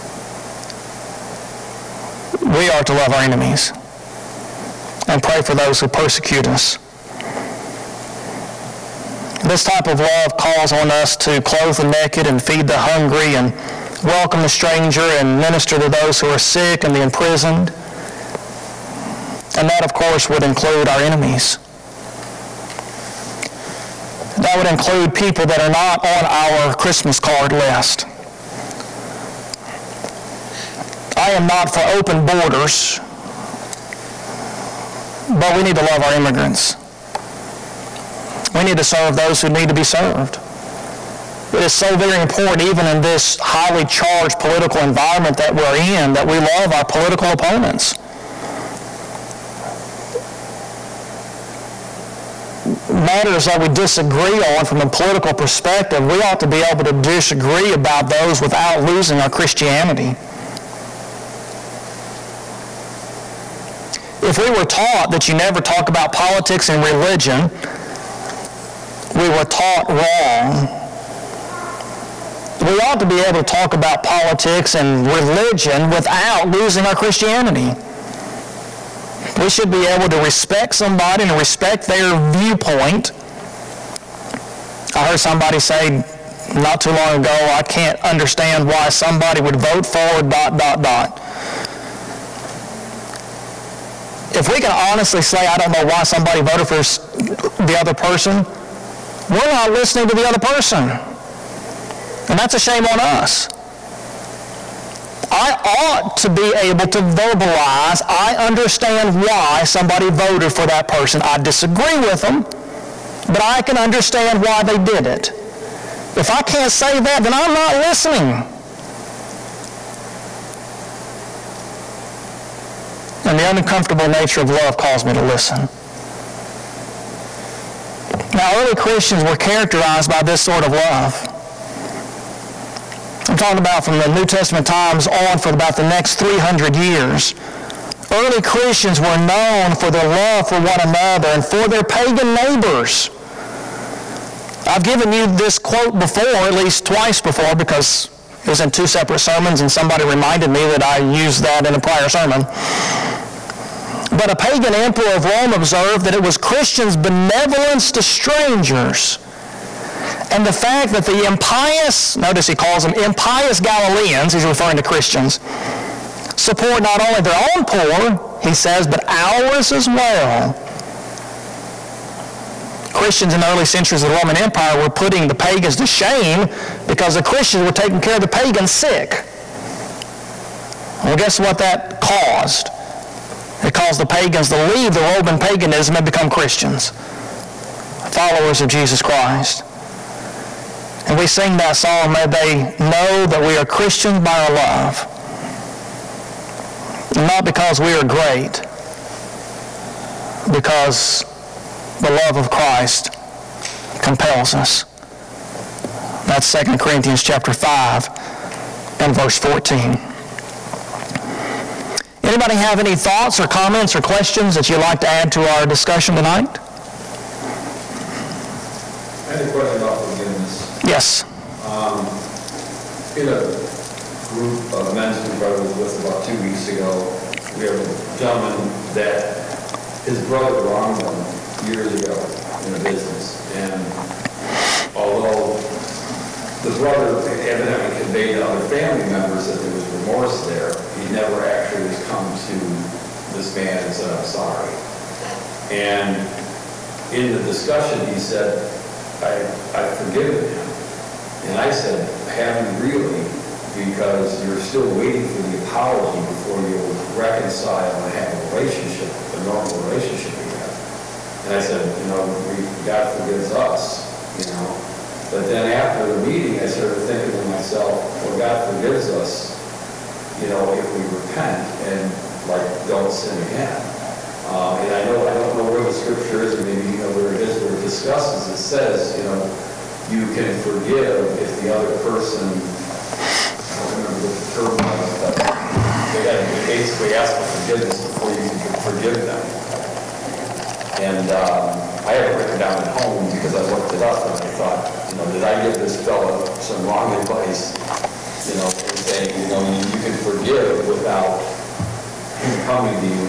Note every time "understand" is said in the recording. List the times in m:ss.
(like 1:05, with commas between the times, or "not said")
1:28, 1:48, 1:53.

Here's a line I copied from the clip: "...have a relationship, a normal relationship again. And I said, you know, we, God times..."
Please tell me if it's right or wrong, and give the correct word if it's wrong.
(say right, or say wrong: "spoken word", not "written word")
wrong: "forgives", not "times".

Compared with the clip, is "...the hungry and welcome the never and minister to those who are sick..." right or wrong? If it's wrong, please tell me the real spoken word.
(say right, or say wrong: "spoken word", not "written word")
wrong: "stranger", not "never".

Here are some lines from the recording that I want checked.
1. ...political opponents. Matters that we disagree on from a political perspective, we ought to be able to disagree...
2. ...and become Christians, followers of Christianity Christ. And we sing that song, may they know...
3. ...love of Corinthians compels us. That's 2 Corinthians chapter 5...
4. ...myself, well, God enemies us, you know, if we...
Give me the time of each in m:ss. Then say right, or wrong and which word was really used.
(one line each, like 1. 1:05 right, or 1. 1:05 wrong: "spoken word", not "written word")
1. 0:46 right
2. 3:05 wrong: "Jesus", not "Christianity"
3. 3:22 wrong: "Christ", not "Corinthians"
4. 4:27 wrong: "forgives", not "enemies".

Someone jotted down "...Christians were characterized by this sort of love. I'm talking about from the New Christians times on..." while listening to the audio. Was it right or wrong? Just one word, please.
wrong.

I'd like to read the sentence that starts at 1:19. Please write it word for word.
We should be able to respect somebody and respect their viewpoint.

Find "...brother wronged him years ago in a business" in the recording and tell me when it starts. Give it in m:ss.
3:50.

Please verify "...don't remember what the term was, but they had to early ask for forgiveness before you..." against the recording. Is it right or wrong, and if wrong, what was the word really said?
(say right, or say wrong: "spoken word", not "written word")
wrong: "basically", not "early".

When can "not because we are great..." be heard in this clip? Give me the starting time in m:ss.
3:17.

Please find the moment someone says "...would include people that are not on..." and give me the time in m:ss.
0:24.